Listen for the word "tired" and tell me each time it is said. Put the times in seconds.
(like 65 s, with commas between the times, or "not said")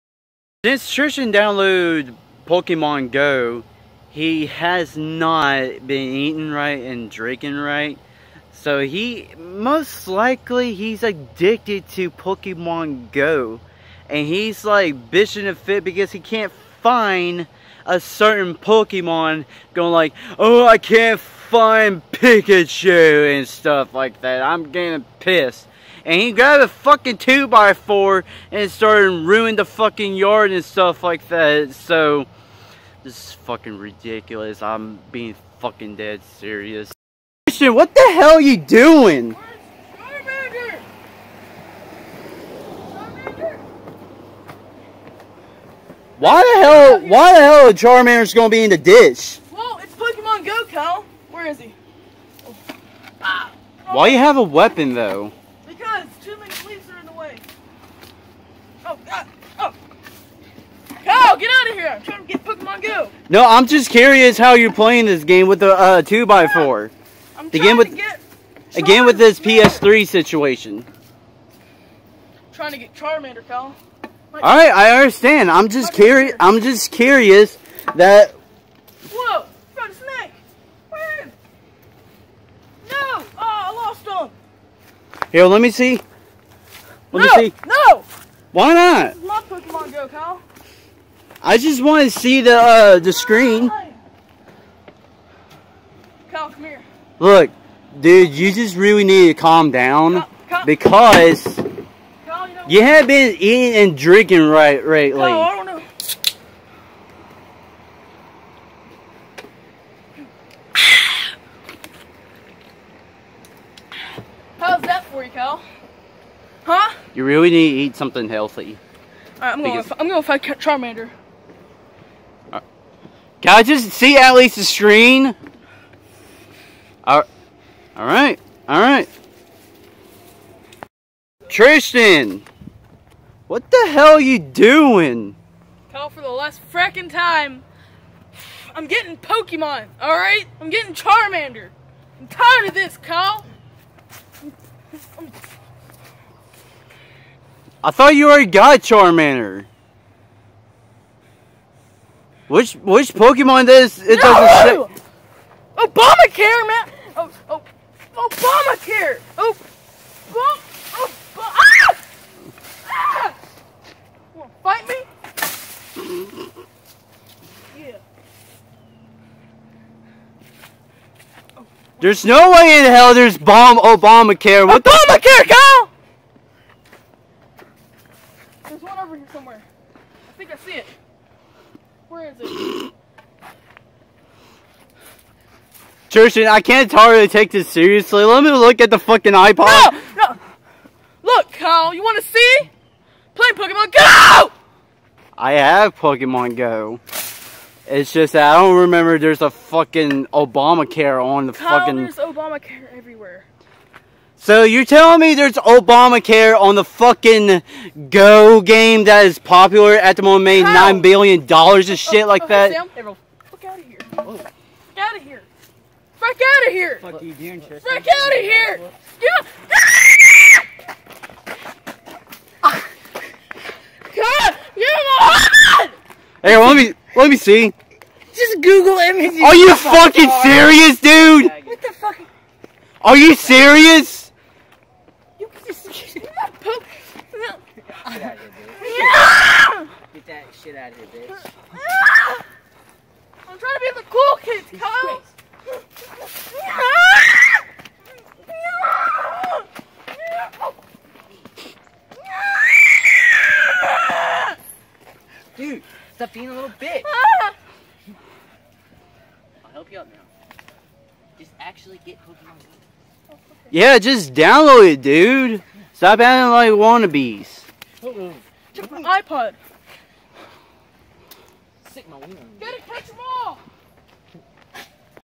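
142 s.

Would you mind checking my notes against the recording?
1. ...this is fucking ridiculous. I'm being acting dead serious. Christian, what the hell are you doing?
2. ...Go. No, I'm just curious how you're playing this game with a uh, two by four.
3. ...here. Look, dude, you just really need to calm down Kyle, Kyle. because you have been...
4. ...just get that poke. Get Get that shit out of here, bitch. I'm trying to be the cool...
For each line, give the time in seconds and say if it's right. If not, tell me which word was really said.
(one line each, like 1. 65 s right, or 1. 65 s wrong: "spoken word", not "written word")
1. 33 s wrong: "fucking", not "acting"
2. 62 s right
3. 96 s right
4. 235 s right.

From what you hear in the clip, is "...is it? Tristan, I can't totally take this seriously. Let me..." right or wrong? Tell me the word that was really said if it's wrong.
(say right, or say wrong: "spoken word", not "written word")
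right.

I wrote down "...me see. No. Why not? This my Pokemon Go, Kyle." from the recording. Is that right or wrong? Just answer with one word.
right.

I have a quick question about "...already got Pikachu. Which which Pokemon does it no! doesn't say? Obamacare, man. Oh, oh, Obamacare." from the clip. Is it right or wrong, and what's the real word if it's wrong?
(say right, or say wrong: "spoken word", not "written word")
wrong: "Charmander", not "Pikachu".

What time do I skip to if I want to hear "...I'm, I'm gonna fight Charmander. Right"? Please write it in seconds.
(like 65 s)
119 s.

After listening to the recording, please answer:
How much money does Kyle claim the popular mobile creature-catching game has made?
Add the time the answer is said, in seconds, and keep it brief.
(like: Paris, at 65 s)
$9 billion, at 210 s.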